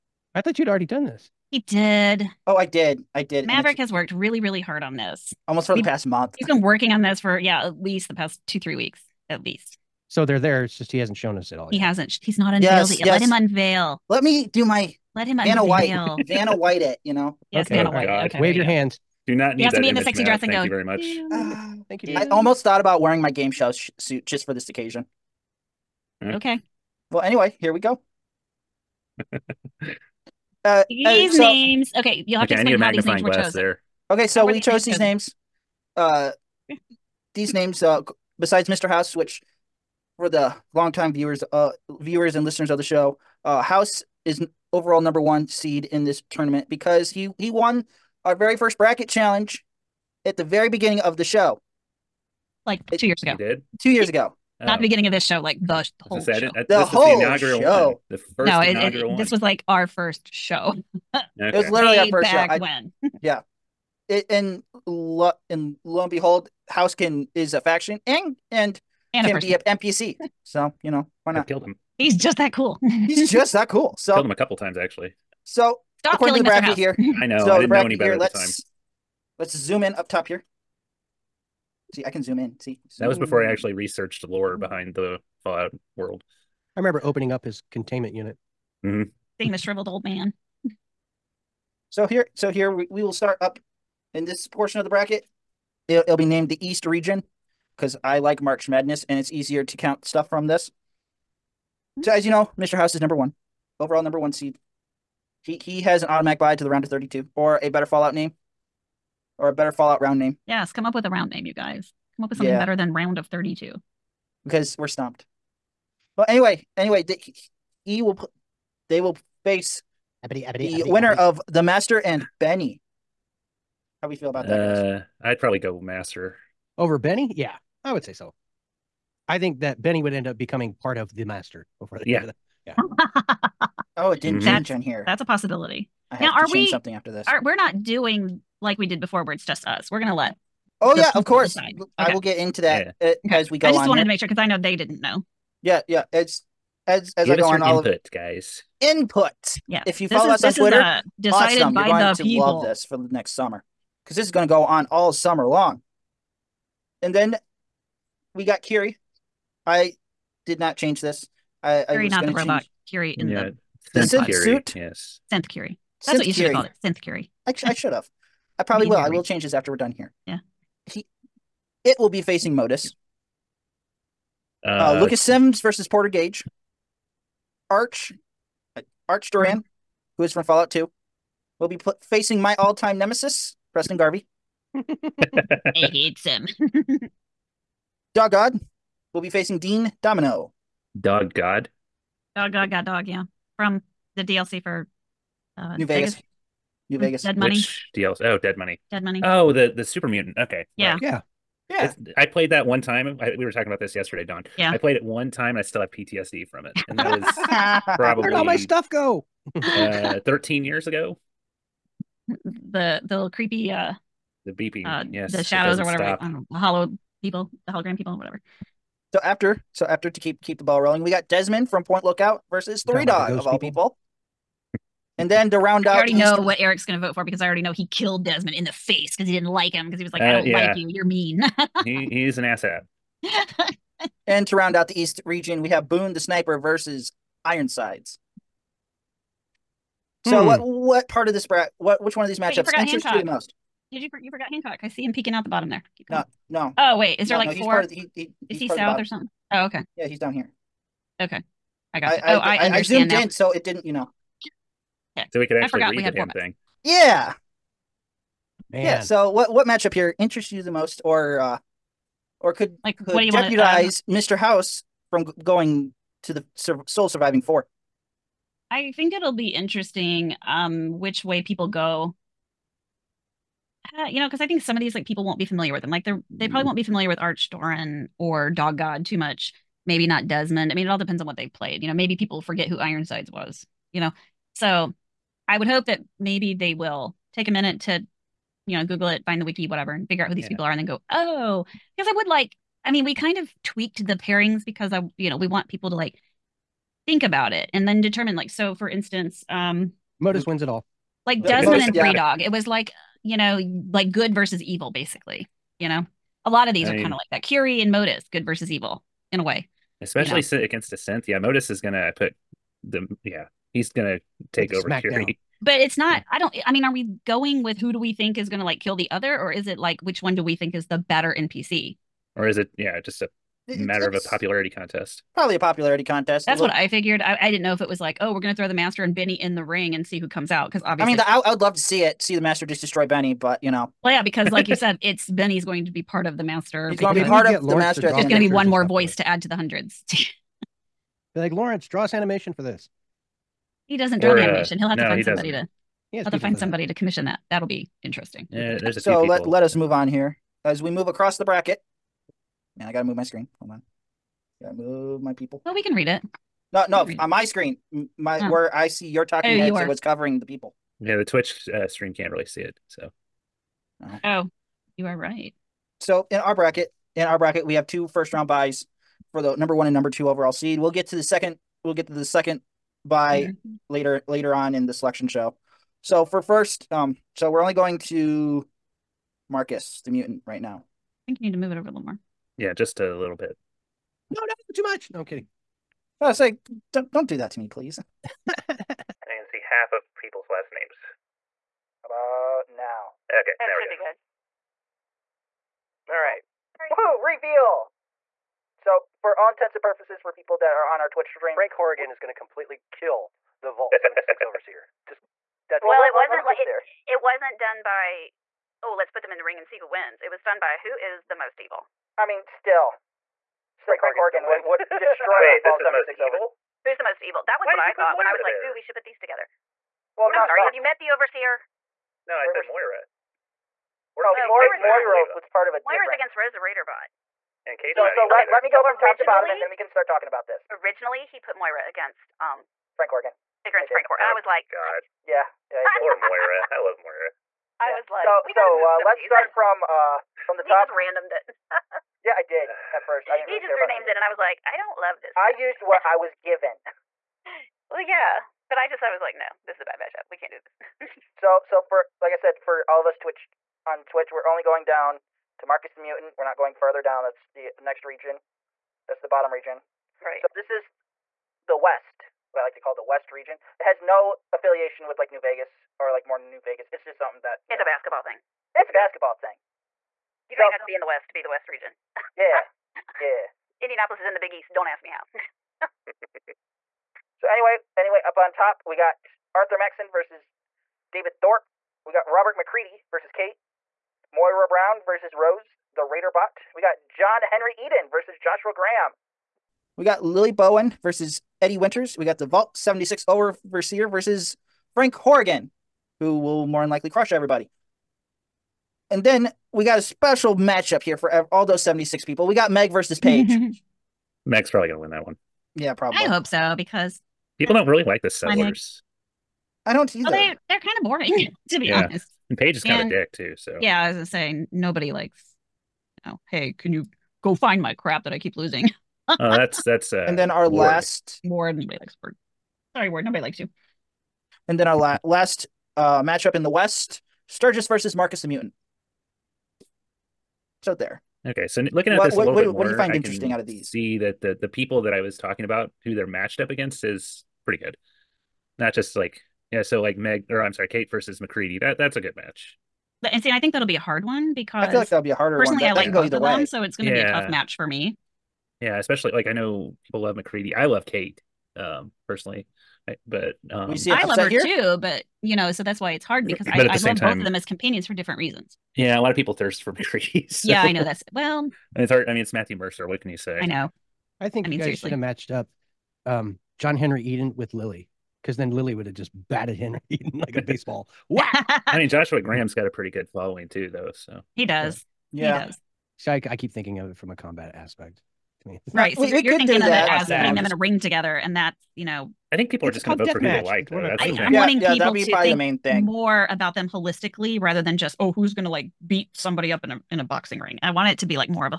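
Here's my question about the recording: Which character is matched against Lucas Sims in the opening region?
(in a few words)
Porter Gage.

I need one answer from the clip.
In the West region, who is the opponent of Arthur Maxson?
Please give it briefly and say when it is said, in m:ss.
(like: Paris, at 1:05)
David Thorpe, at 8:01.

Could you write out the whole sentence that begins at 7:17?
was like, so, so uh, let's start from uh from the top.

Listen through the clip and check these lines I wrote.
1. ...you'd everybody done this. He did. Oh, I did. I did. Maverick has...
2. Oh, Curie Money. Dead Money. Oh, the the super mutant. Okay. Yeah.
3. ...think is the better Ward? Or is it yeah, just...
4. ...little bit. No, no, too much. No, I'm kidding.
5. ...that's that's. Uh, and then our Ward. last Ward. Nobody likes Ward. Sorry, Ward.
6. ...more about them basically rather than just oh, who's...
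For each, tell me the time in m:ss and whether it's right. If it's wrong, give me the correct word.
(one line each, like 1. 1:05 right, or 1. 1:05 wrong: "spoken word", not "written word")
1. 0:00 wrong: "already", not "everybody"
2. 3:18 wrong: "Dead", not "Curie"
3. 5:20 wrong: "NPC", not "Ward"
4. 6:23 right
5. 8:39 right
6. 9:46 wrong: "holistically", not "basically".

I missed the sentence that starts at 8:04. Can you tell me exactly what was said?
Moira Brown versus Rose, the Raider bot.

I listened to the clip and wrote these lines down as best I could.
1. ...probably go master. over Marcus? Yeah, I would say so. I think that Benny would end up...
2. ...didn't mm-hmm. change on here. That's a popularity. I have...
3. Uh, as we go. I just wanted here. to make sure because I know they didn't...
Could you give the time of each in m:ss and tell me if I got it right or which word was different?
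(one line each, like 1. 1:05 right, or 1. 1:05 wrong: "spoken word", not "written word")
1. 2:05 wrong: "Benny", not "Marcus"
2. 2:14 wrong: "possibility", not "popularity"
3. 2:23 right.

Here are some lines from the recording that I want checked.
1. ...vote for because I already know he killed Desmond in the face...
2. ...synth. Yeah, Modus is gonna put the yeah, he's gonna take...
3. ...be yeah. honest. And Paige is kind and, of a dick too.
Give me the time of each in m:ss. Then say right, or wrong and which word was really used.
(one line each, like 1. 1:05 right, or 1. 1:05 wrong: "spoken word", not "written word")
1. 3:47 right
2. 5:10 right
3. 8:31 right.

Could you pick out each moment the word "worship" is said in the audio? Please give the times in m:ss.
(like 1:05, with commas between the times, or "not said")
not said.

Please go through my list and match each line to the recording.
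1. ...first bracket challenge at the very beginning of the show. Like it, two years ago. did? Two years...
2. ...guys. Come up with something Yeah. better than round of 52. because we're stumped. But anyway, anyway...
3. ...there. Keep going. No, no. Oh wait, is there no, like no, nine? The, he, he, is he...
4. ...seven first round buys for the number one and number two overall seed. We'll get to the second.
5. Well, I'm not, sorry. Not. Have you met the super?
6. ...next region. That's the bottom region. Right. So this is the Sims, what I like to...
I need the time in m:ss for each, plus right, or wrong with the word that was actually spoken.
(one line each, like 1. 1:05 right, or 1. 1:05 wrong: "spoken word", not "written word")
1. 0:48 right
2. 1:51 wrong: "32", not "52"
3. 4:05 wrong: "four", not "nine"
4. 6:07 wrong: "two", not "seven"
5. 7:00 wrong: "overseer", not "super"
6. 7:37 wrong: "West", not "Sims".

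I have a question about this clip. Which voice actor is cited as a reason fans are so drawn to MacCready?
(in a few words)
Matthew Mercer.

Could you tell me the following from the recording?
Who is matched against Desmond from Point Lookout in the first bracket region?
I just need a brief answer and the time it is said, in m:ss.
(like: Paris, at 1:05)
Three Dog, at 3:42.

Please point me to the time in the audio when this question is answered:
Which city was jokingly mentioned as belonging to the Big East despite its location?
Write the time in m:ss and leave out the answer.
7:53.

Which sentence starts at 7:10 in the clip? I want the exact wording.
Originally, he put Moira against um Frank Horrigan.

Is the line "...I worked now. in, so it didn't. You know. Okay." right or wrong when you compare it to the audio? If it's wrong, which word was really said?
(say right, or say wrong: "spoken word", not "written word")
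wrong: "zoomed", not "worked".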